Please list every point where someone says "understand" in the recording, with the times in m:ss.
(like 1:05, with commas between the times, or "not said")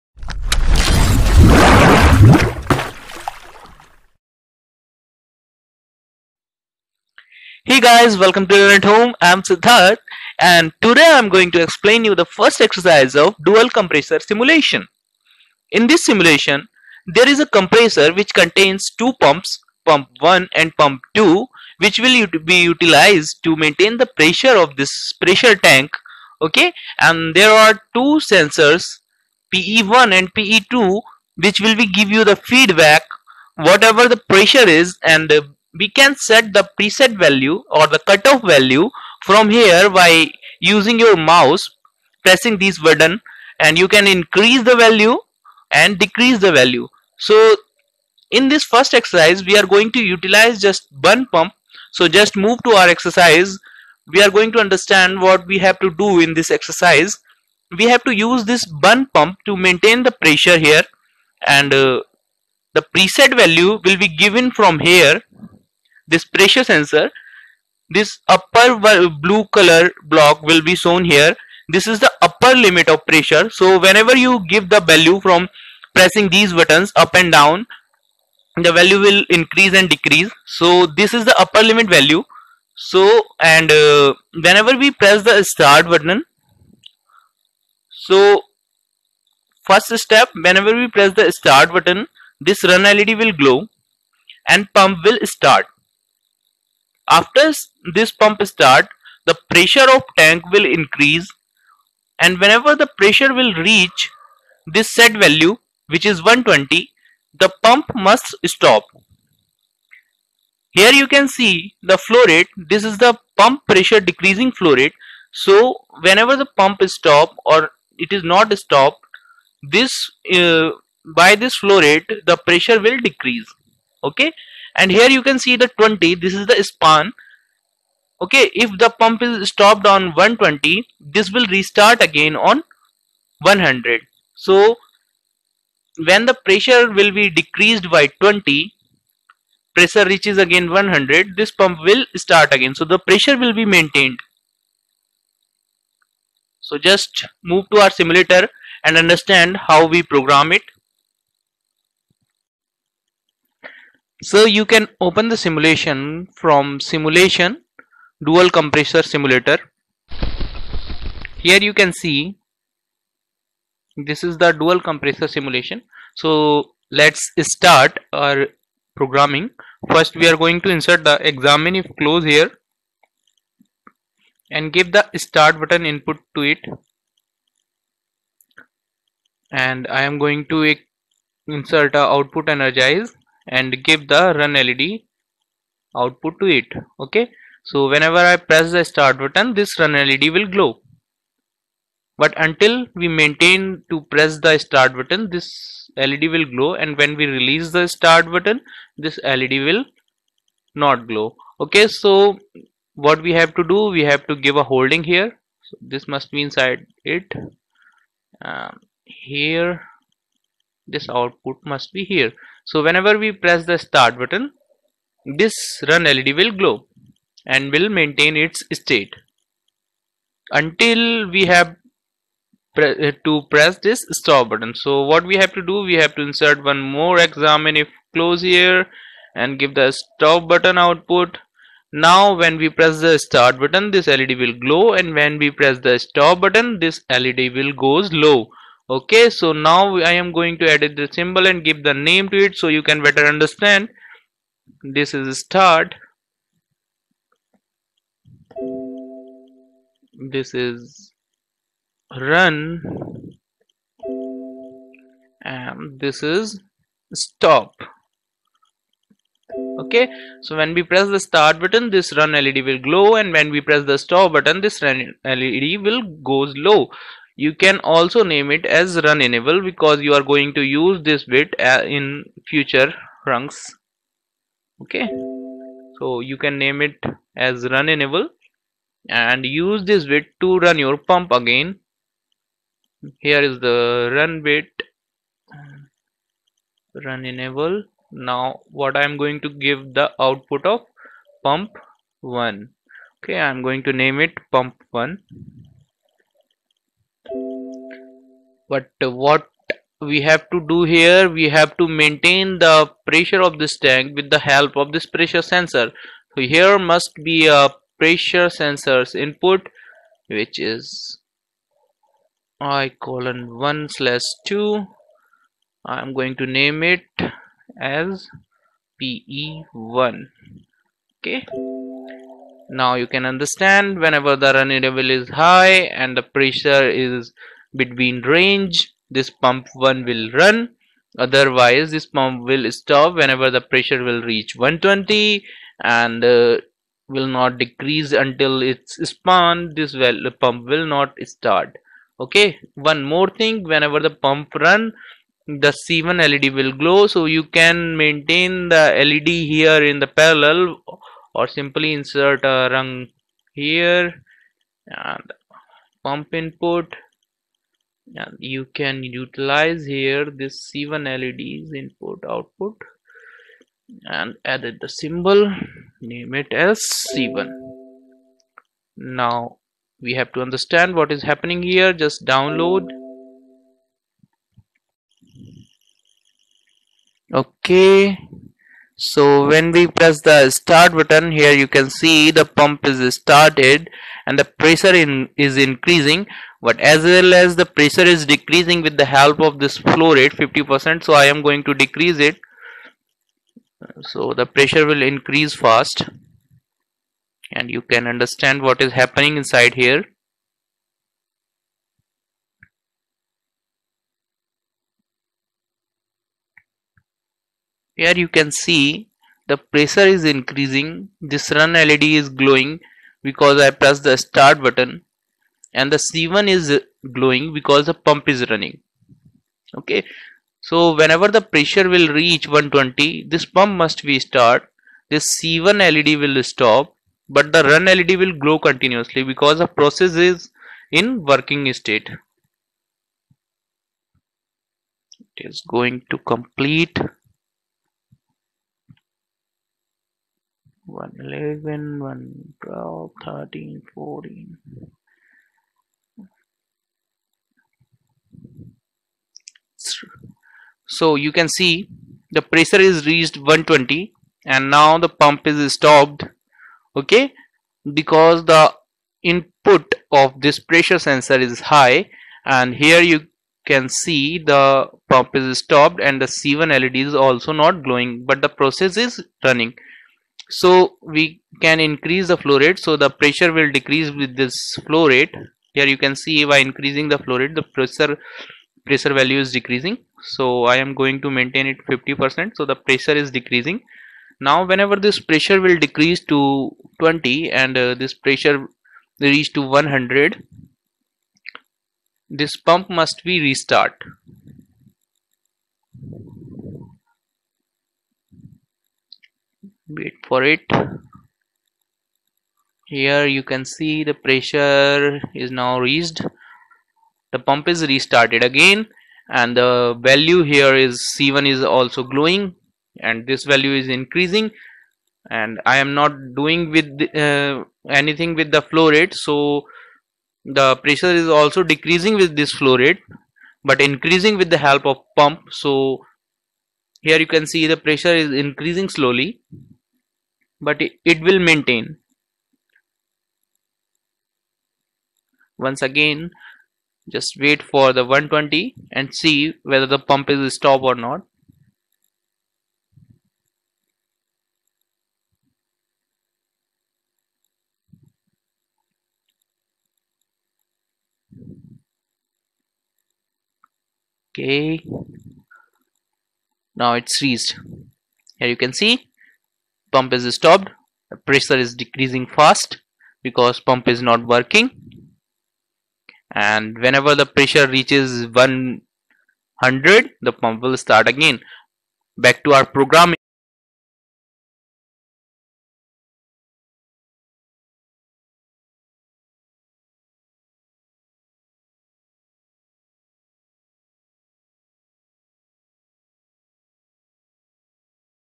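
0:54, 2:28, 4:03, 5:23, 6:10, 6:38.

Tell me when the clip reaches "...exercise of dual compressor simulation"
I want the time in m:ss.
0:12.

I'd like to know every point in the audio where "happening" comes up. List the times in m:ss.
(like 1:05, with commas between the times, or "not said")
6:11, 6:38.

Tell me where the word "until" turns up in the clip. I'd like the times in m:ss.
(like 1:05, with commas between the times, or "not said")
3:12, 3:40, 5:38.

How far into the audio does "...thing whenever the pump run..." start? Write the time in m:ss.
5:43.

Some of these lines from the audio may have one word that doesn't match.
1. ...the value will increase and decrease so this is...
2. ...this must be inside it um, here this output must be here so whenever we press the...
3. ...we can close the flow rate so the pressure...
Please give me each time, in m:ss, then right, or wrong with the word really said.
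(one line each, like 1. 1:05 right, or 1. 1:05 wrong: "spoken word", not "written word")
1. 1:18 right
2. 3:25 right
3. 7:51 wrong: "increase", not "close".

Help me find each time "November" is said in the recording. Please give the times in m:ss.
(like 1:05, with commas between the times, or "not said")
not said.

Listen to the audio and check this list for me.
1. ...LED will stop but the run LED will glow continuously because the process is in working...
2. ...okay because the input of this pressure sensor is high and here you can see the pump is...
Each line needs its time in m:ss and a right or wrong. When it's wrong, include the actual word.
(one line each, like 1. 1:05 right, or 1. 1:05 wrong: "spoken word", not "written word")
1. 7:05 right
2. 7:37 right.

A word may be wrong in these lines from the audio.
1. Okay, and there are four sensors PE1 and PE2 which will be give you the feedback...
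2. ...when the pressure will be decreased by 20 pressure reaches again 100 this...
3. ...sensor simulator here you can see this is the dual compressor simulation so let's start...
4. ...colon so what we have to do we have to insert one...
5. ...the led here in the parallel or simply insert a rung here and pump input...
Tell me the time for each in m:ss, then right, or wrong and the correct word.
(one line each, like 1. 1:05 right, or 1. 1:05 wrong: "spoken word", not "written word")
1. 0:26 wrong: "two", not "four"
2. 2:16 right
3. 2:38 wrong: "compressor", not "sensor"
4. 3:44 wrong: "button", not "colon"
5. 5:48 right.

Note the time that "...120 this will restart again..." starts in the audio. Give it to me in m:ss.
2:10.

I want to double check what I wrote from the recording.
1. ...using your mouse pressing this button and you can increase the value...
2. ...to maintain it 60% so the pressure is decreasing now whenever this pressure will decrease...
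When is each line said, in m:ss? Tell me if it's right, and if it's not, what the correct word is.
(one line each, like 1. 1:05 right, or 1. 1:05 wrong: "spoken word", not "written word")
1. 0:40 right
2. 8:01 wrong: "50", not "60".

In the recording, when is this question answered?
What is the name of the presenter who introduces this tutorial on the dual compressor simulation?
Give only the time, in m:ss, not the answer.
0:09.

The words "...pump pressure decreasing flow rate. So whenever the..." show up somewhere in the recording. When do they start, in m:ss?
1:53.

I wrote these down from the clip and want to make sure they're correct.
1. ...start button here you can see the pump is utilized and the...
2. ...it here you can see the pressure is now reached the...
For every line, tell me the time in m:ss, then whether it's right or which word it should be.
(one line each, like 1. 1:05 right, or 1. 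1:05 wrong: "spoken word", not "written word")
1. 6:20 wrong: "started", not "utilized"
2. 8:20 right.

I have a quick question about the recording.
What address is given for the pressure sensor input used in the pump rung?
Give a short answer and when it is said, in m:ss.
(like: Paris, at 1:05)
I:1/2, at 5:12.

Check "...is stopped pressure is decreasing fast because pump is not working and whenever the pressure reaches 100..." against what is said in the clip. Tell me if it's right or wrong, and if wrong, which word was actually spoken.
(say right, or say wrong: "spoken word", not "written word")
right.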